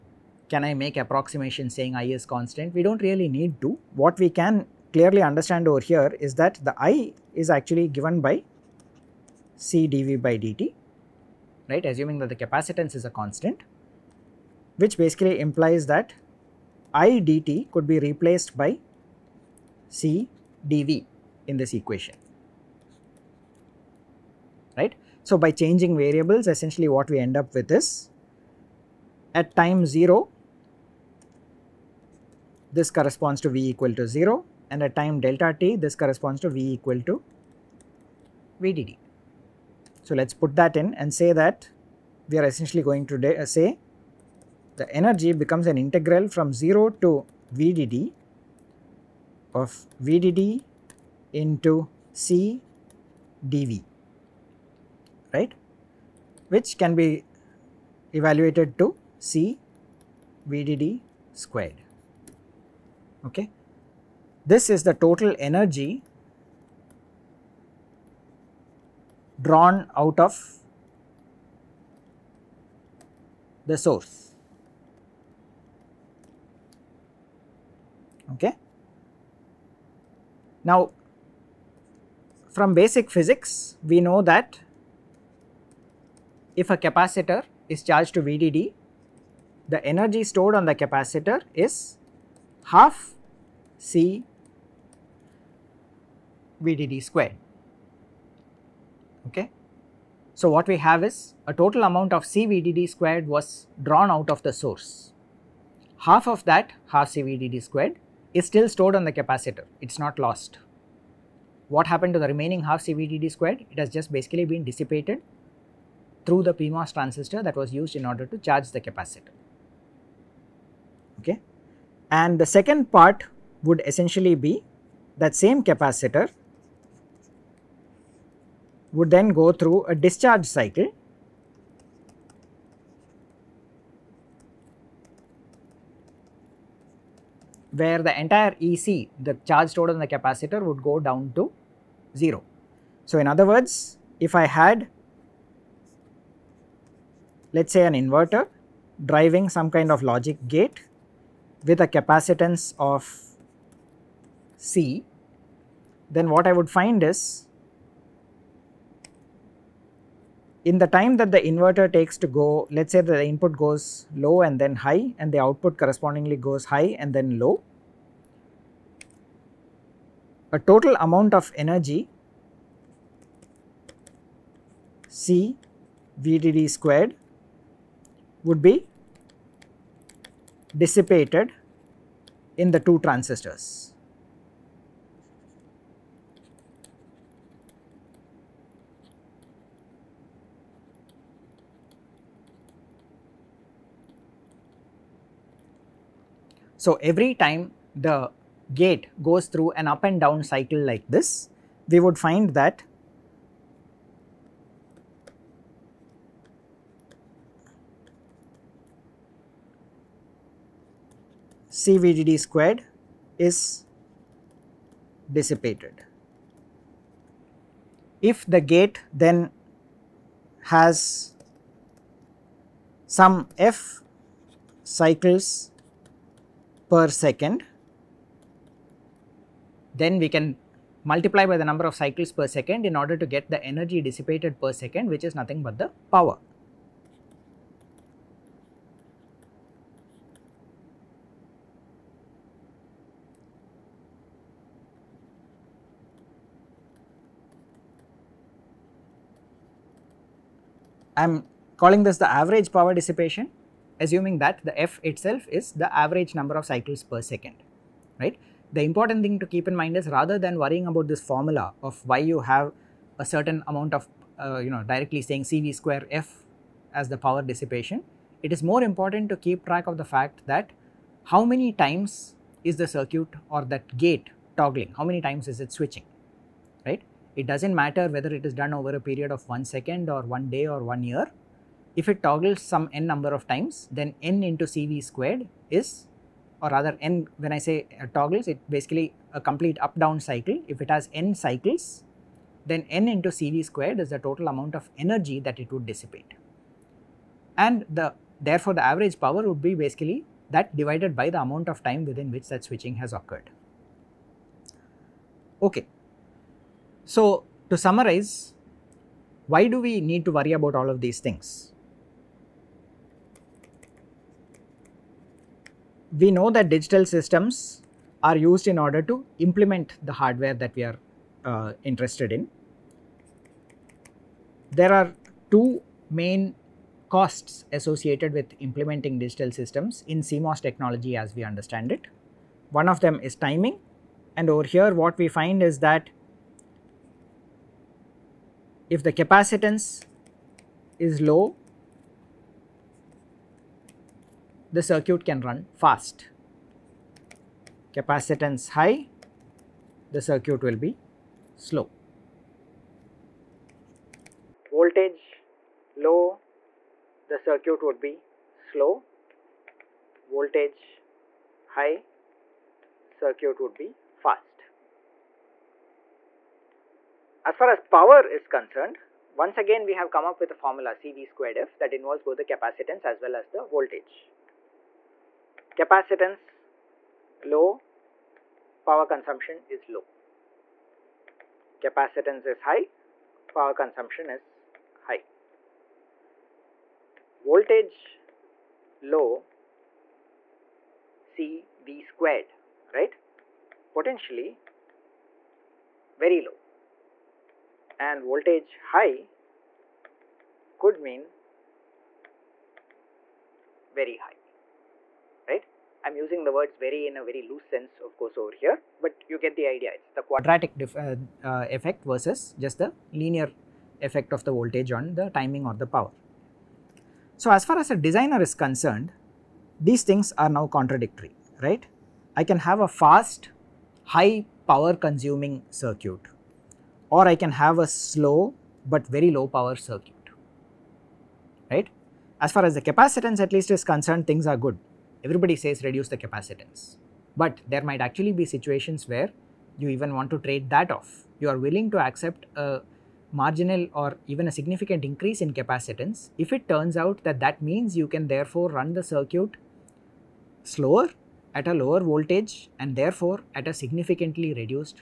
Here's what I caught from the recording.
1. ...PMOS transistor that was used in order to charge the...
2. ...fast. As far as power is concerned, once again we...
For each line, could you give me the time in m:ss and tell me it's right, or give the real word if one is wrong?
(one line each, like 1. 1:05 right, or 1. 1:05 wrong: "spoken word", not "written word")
1. 1:56 right
2. 6:04 right.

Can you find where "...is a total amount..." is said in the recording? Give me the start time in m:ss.
1:41.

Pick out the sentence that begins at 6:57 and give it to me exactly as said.
So, as far as a designer is concerned, these things are now contradictory, right?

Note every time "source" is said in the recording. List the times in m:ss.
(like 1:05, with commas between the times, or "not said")
1:13, 1:44.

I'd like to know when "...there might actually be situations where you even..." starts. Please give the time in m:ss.
7:17.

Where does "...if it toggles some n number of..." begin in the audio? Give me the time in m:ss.
4:41.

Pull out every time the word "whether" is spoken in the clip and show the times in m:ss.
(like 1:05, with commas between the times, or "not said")
4:38.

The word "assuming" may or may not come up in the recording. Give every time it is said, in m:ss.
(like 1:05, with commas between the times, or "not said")
0:11, 4:14.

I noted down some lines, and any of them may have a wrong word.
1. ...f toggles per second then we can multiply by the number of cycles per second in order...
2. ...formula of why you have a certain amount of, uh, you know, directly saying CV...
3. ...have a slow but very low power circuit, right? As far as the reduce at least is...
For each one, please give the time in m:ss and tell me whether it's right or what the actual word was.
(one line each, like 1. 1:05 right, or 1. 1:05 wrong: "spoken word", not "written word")
1. 3:43 wrong: "cycles", not "toggles"
2. 4:21 right
3. 7:07 wrong: "capacitance", not "reduce".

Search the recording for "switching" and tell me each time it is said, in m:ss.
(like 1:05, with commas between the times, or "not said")
4:35, 5:02.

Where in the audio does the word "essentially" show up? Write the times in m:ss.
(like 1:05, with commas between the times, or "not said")
0:26, 0:42, 2:03.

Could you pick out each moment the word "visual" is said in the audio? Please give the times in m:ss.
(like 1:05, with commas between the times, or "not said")
not said.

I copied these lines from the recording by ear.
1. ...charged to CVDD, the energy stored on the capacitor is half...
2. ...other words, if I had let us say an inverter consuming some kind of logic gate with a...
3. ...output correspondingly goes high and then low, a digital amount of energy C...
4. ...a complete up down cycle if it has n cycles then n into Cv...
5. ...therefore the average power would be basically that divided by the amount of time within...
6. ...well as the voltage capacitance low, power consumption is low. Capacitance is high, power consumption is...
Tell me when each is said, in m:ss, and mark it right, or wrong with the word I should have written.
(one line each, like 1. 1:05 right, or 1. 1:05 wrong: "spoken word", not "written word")
1. 1:27 wrong: "VDD", not "CVDD"
2. 2:23 wrong: "driving", not "consuming"
3. 2:45 wrong: "total", not "digital"
4. 4:49 right
5. 4:58 right
6. 6:13 right.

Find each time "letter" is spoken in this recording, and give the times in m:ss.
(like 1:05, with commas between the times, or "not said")
not said.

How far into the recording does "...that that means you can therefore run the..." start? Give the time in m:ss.
7:27.